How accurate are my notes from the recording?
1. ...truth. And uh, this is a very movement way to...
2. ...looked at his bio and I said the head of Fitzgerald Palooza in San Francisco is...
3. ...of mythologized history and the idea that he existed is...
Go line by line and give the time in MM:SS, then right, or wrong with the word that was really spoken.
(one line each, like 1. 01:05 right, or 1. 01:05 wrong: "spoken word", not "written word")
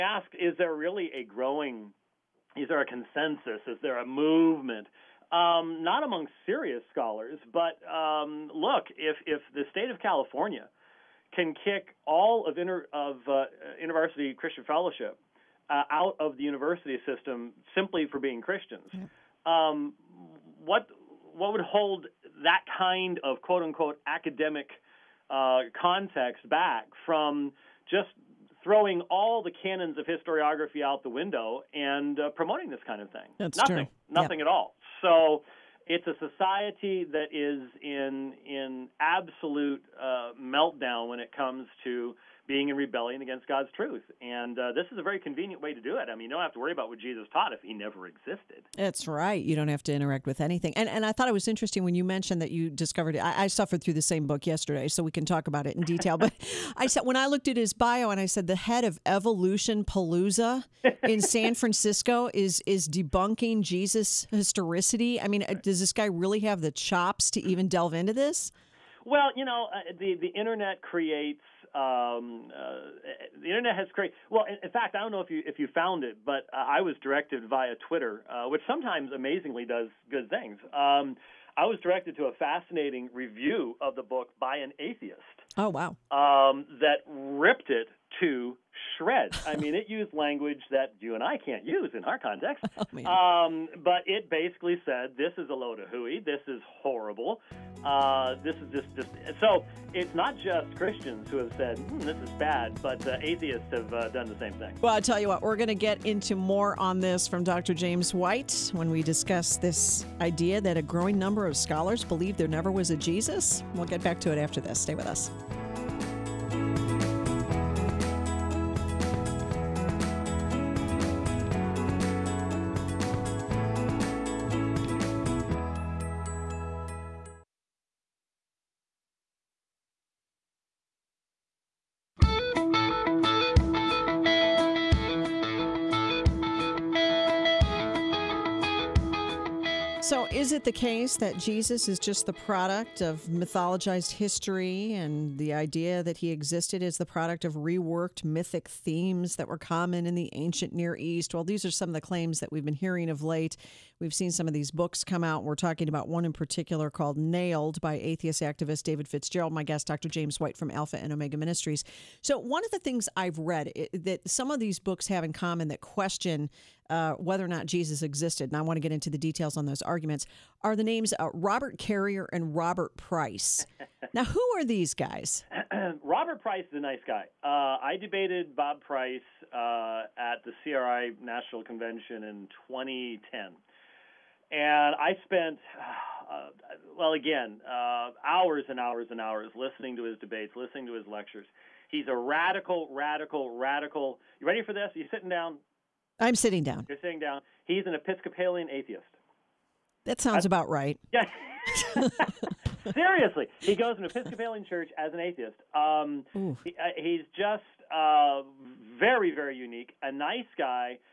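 1. 00:43 wrong: "convenient", not "movement"
2. 00:57 wrong: "Evolution", not "Fitzgerald"
3. 02:23 right.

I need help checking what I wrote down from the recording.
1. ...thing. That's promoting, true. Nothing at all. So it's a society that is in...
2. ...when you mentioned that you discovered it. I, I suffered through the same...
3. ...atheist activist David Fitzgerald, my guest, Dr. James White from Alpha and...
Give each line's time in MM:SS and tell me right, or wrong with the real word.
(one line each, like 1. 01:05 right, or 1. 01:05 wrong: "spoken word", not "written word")
1. 00:33 wrong: "nothing", not "promoting"
2. 00:51 right
3. 02:37 right.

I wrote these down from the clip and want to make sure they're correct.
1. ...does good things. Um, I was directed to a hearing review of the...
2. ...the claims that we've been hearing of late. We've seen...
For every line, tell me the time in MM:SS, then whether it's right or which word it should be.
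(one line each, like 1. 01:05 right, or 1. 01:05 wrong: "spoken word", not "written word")
1. 01:19 wrong: "fascinating", not "hearing"
2. 02:31 right.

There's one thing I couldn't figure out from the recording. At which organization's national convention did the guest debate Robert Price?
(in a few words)
CRI.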